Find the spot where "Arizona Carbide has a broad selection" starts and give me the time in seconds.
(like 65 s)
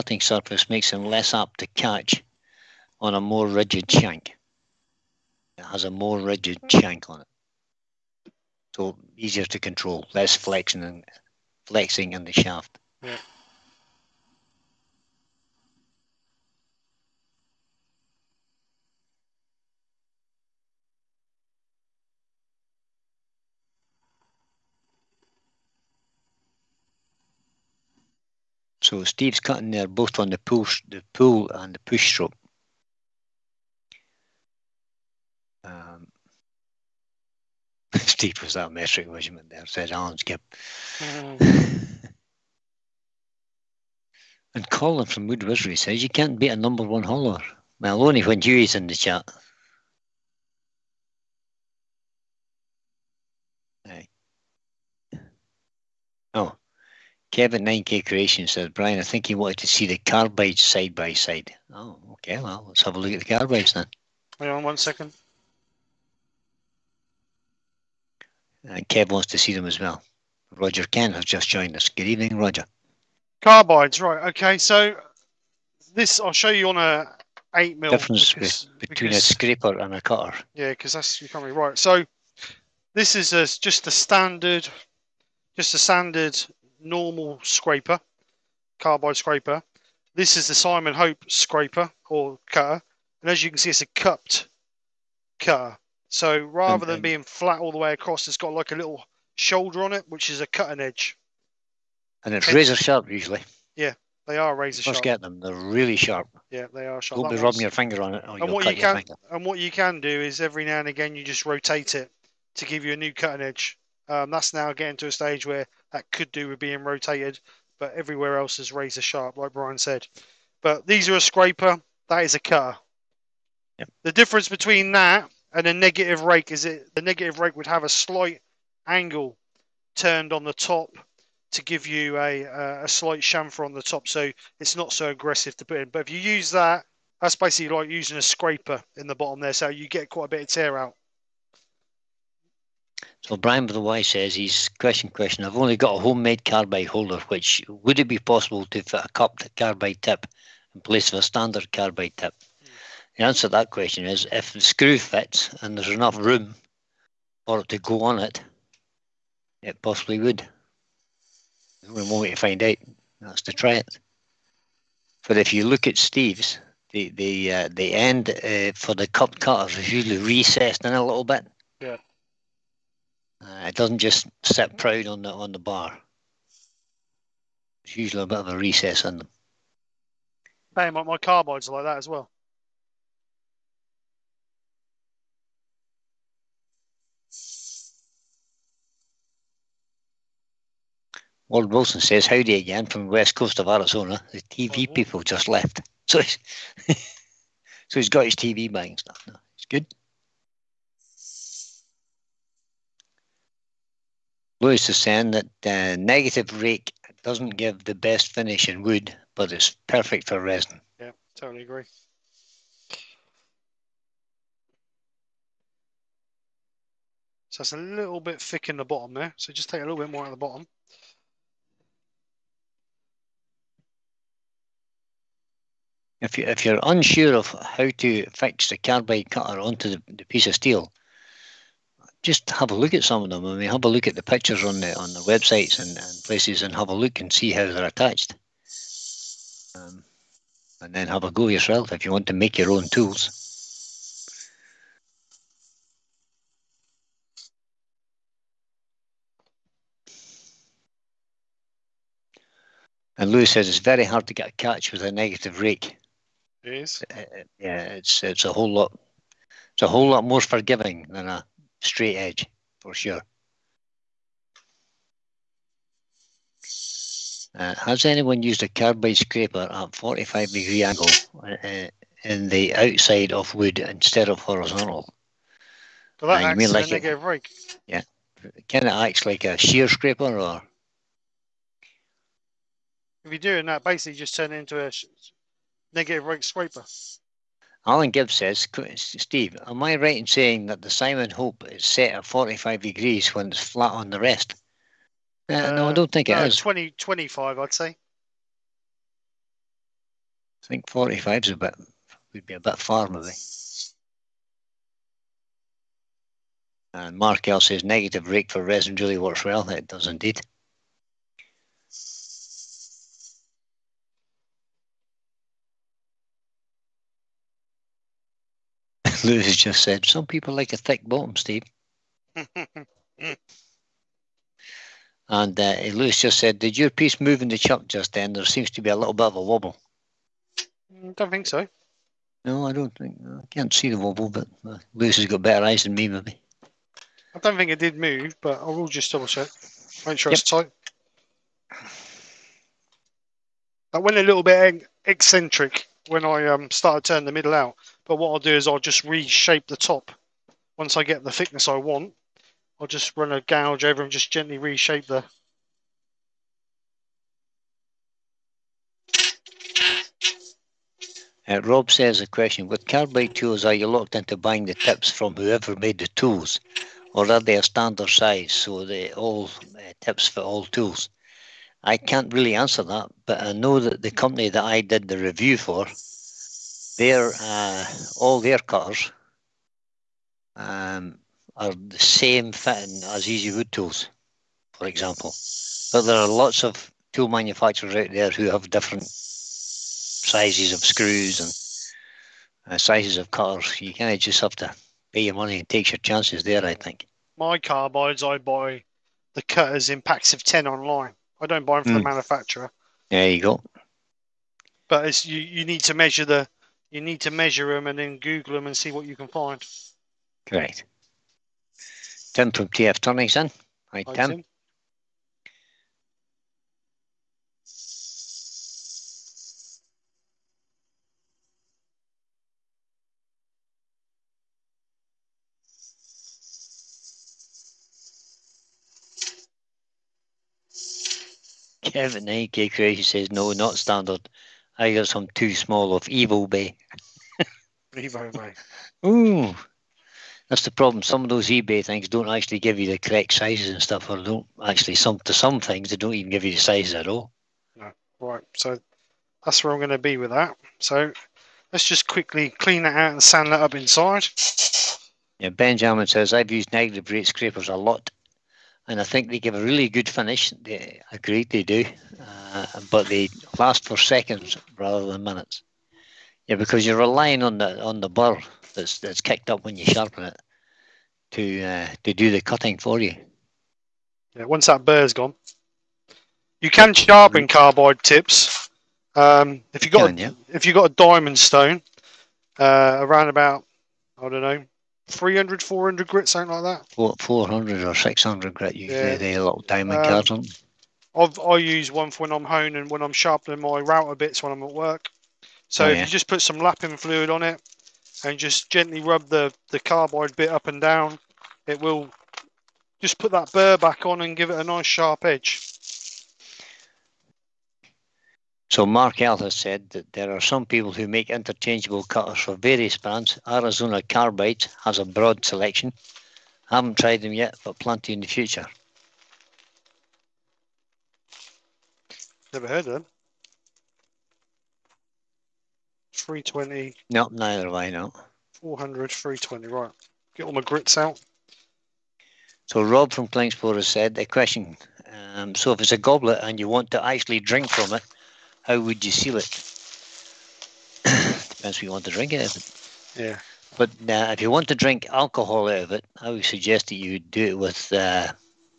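513 s.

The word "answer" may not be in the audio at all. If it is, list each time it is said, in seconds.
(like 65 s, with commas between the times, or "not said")
153 s, 372 s.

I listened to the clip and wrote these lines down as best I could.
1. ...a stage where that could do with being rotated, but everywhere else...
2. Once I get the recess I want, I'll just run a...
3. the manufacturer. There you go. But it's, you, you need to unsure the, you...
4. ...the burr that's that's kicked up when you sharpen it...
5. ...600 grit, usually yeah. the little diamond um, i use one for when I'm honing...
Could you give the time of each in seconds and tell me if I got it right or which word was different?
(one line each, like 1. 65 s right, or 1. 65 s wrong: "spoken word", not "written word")
1. 115 s right
2. 350 s wrong: "thickness", not "recess"
3. 402 s wrong: "measure", not "unsure"
4. 468 s right
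5. 487 s right.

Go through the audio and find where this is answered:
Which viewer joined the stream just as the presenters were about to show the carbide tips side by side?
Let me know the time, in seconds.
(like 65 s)
70 s.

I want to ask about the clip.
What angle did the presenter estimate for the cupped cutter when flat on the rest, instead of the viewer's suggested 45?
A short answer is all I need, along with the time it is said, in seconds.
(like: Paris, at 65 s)
20 to 25 degrees, at 296 s.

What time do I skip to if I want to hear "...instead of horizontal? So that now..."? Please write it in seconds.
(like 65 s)
273 s.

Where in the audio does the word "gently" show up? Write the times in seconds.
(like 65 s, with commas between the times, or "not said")
354 s, 498 s.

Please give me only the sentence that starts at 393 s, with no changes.
You kind of just have to pay your money and take your chances there, I think.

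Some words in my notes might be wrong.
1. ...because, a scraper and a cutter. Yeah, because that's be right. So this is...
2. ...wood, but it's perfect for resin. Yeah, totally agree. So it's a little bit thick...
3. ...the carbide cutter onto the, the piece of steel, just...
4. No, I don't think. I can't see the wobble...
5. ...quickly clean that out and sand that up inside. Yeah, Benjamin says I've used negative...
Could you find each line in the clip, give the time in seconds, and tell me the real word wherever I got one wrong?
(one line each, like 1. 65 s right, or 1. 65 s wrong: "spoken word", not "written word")
1. 79 s right
2. 208 s right
3. 228 s right
4. 332 s right
5. 452 s right.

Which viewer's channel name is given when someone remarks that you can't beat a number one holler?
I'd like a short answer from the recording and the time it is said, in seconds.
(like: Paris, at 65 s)
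Wood Wizardry, at 45 s.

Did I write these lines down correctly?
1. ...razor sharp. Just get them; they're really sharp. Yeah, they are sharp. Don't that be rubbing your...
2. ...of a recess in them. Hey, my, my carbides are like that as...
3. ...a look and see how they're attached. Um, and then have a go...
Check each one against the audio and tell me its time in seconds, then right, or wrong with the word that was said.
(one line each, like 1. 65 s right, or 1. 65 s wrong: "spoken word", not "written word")
1. 104 s right
2. 178 s right
3. 236 s right.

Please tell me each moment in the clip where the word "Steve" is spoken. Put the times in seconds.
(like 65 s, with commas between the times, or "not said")
29 s, 37 s, 165 s, 288 s, 321 s.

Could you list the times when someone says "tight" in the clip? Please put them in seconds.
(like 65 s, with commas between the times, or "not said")
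340 s.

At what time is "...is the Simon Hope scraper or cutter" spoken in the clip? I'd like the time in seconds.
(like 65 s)
90 s.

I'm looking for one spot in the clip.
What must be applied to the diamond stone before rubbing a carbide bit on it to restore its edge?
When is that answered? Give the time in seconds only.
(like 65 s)
496 s.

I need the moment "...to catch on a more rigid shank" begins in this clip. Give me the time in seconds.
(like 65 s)
1 s.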